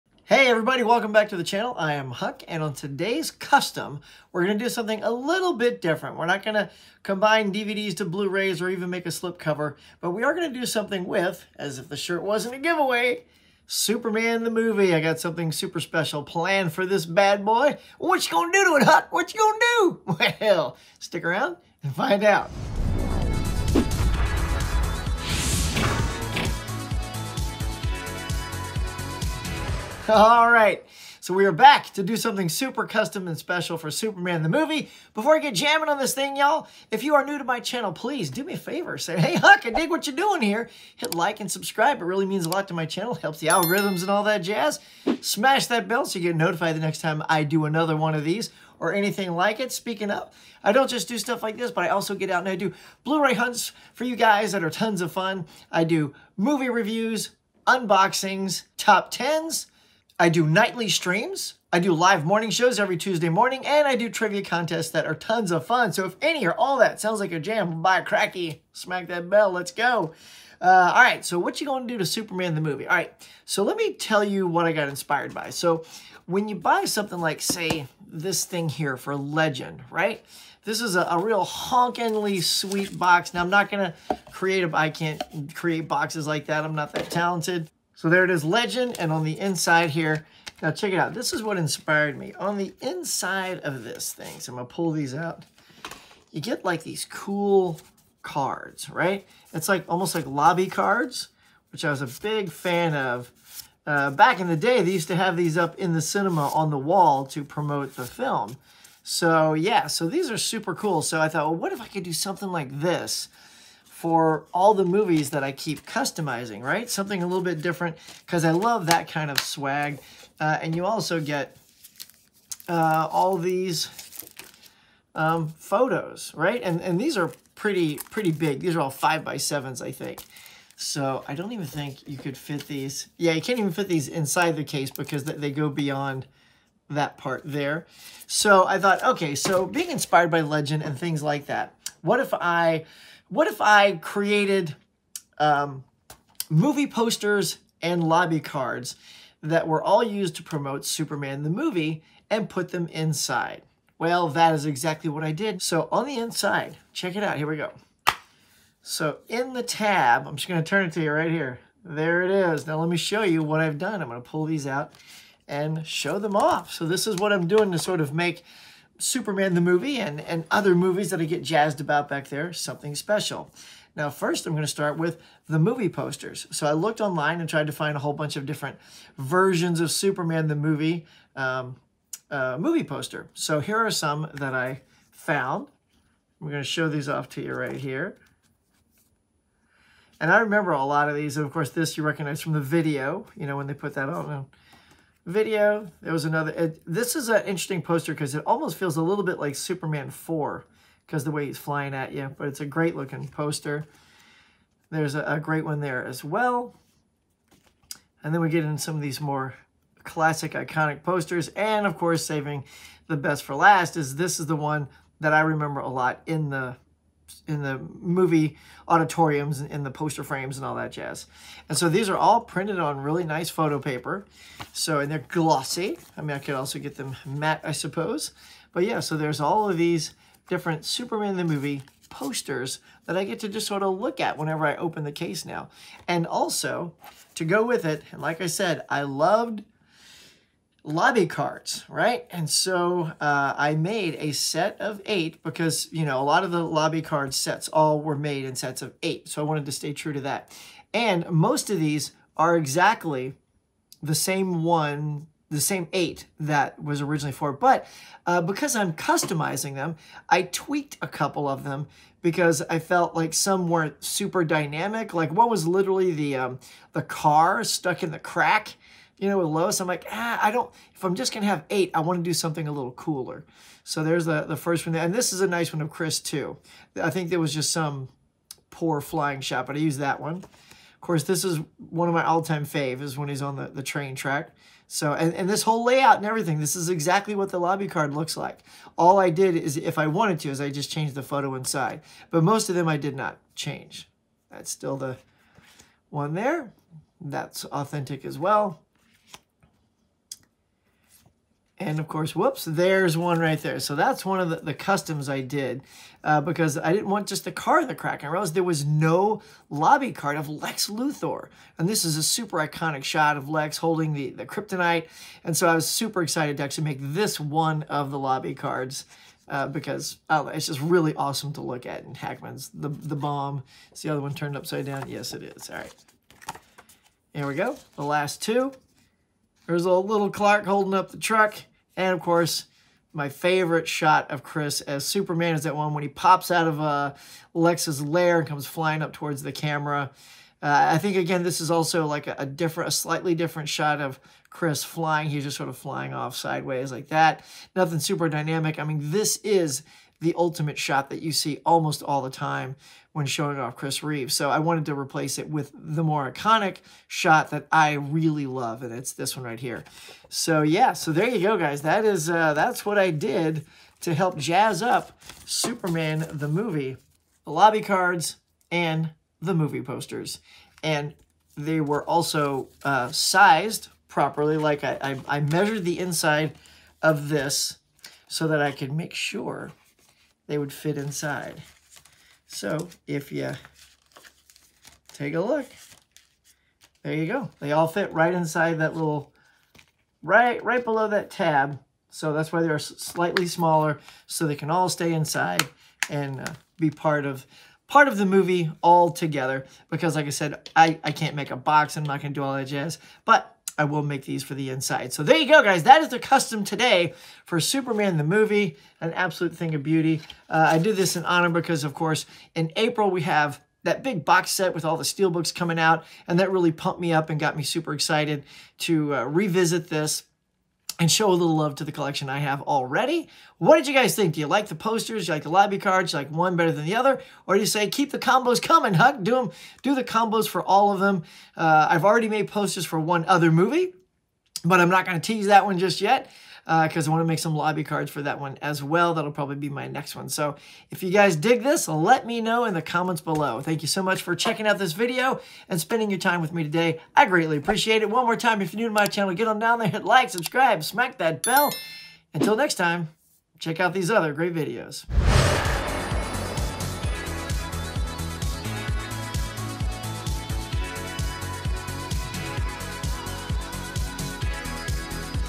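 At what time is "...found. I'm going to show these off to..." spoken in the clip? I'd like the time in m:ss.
3:05.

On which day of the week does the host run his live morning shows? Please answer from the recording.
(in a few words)
Tuesday.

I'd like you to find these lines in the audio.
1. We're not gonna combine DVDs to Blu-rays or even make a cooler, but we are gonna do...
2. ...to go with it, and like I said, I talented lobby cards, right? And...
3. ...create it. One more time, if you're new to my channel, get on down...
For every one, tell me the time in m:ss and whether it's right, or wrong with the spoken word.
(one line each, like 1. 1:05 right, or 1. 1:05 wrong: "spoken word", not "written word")
1. 0:06 wrong: "slipcover", not "cooler"
2. 3:57 wrong: "loved", not "talented"
3. 7:27 wrong: "appreciate", not "create".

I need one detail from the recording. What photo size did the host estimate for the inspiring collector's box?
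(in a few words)
5 by 7.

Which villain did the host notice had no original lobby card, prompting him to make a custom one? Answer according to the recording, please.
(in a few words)
Lex Luthor.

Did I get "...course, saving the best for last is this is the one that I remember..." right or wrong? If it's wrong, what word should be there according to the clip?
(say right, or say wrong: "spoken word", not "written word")
right.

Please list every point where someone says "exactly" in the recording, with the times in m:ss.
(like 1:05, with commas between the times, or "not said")
2:34, 4:12, 4:46.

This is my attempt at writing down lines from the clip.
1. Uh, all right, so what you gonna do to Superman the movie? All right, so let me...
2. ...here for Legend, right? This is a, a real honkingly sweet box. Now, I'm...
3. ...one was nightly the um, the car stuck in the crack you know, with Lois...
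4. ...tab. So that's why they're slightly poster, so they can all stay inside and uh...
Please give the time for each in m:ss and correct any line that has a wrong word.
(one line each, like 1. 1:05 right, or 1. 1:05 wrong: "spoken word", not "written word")
1. 1:10 right
2. 1:18 right
3. 4:25 wrong: "literally", not "nightly"
4. 6:31 wrong: "smaller", not "poster".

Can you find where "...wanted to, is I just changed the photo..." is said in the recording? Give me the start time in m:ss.
4:50.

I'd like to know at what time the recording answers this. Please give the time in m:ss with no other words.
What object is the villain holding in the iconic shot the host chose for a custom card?
5:14.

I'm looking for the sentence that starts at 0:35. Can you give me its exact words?
Before I get jamming on this thing, y'all, if you are new to my channel, please do me a favor.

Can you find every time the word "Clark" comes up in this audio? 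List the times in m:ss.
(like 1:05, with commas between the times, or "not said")
5:30.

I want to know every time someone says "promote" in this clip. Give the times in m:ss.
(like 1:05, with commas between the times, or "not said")
1:47, 2:30.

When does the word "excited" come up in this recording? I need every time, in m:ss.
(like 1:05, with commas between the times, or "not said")
5:16, 6:57.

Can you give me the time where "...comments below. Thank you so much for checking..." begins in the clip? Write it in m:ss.
7:22.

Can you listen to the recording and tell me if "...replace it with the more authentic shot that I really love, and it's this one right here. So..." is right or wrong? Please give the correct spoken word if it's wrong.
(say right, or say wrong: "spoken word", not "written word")
wrong: "iconic", not "authentic".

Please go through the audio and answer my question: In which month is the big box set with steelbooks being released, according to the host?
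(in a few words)
April.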